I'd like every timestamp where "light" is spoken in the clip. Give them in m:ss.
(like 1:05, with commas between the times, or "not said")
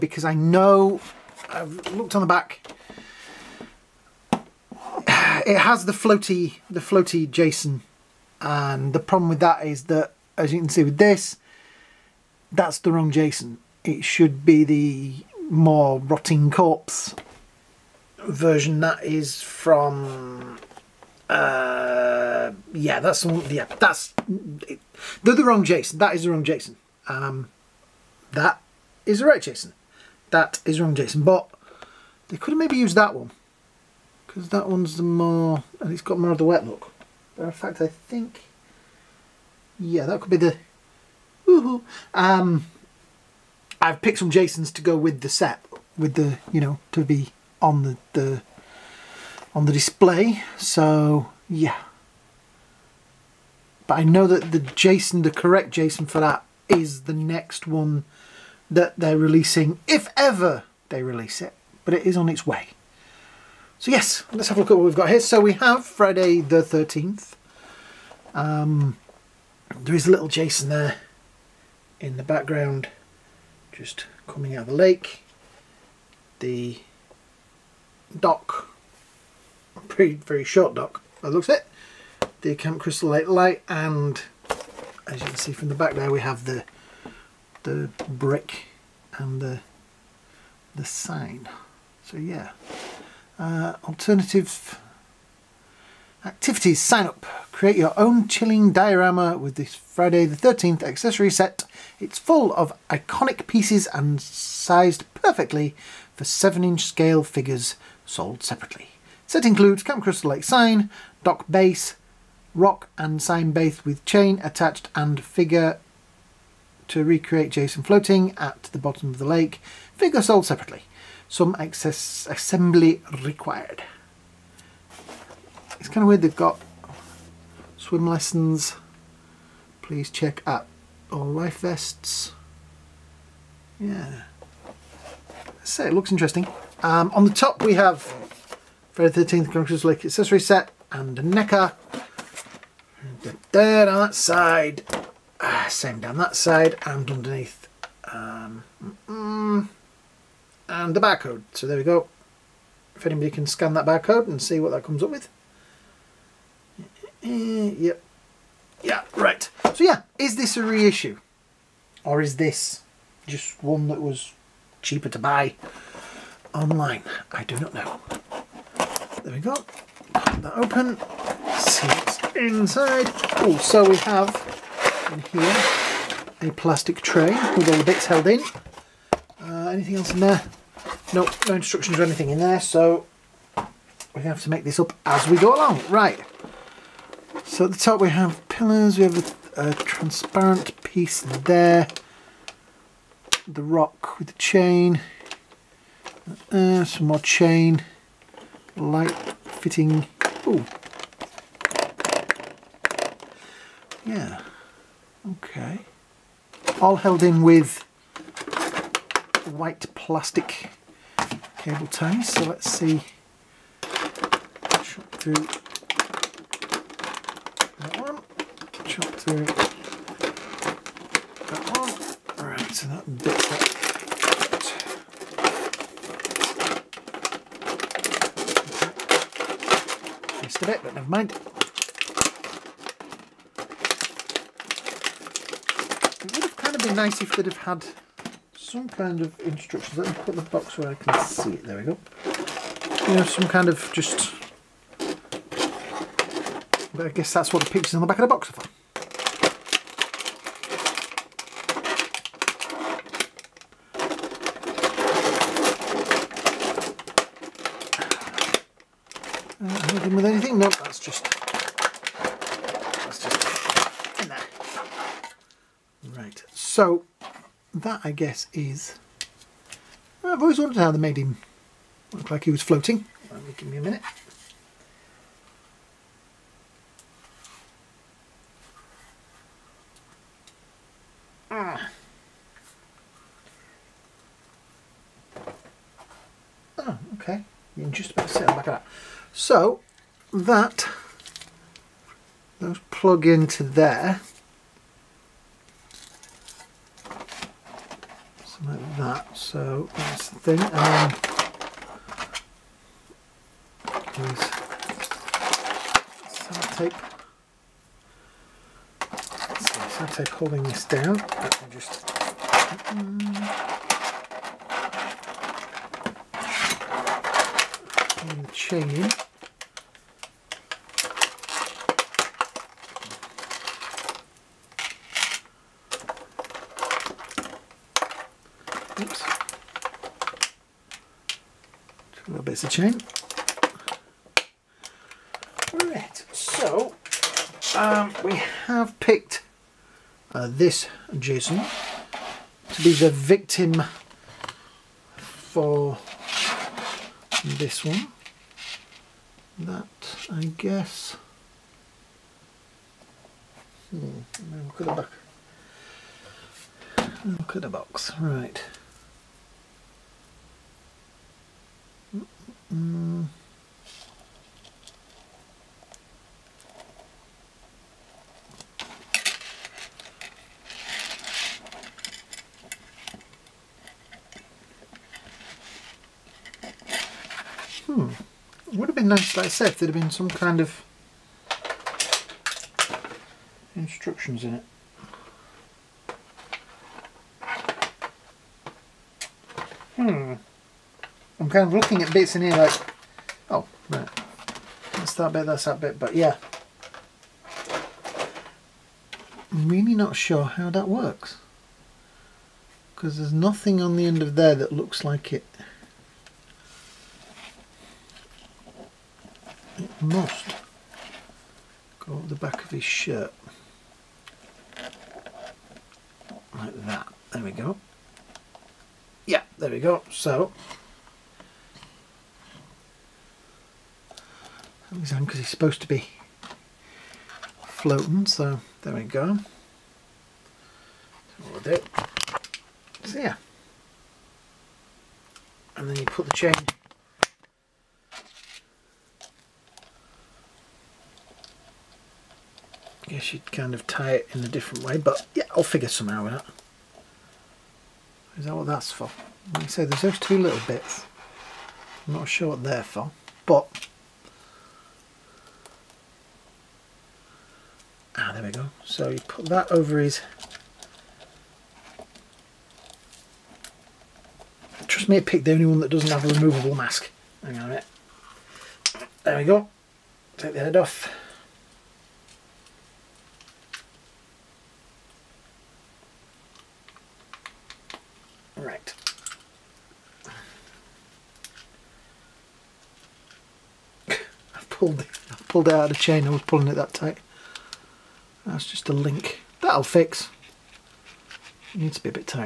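1:23, 3:18.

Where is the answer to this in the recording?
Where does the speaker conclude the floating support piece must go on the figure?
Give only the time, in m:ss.
6:52.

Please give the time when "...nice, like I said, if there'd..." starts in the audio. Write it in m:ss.
6:19.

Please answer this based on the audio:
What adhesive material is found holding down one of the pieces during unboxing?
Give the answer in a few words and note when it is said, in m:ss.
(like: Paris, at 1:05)
Sellotape, at 5:06.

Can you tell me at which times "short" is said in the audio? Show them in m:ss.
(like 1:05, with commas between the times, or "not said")
1:20.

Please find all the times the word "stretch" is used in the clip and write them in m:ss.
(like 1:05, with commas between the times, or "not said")
not said.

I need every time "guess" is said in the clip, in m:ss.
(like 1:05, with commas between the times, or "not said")
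4:07, 4:28, 5:50, 7:23.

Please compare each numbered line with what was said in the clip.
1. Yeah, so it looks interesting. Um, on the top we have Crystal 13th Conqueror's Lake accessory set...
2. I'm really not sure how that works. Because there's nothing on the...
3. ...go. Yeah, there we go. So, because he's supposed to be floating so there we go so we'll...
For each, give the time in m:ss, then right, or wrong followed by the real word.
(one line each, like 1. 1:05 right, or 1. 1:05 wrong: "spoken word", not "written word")
1. 2:13 wrong: "Friday", not "Crystal"
2. 6:39 right
3. 6:57 right.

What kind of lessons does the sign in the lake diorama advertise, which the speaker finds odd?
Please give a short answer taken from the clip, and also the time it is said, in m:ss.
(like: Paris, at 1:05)
Swim lessons, at 2:07.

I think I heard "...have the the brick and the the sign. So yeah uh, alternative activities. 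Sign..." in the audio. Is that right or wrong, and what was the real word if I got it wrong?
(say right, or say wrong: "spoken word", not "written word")
right.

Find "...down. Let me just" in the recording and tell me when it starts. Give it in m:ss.
5:10.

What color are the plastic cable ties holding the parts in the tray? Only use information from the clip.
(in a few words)
White.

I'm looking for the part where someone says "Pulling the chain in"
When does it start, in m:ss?
5:18.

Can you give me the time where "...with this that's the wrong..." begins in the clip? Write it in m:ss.
0:10.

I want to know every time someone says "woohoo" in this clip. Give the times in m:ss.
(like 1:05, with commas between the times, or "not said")
0:41.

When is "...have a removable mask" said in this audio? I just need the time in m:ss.
7:46.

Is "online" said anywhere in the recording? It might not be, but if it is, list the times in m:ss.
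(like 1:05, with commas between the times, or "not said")
2:46.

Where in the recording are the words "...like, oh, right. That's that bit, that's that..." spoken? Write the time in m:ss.
6:32.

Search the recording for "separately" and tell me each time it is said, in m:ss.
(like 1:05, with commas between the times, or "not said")
1:48, 2:00.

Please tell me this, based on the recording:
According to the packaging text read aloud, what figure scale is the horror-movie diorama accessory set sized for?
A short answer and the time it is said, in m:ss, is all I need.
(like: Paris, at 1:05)
7-inch, at 1:46.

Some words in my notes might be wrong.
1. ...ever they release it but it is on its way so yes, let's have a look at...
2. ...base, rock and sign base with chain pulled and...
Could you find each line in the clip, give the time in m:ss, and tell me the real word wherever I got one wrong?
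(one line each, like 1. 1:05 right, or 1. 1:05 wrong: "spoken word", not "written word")
1. 1:00 right
2. 1:51 wrong: "attached", not "pulled".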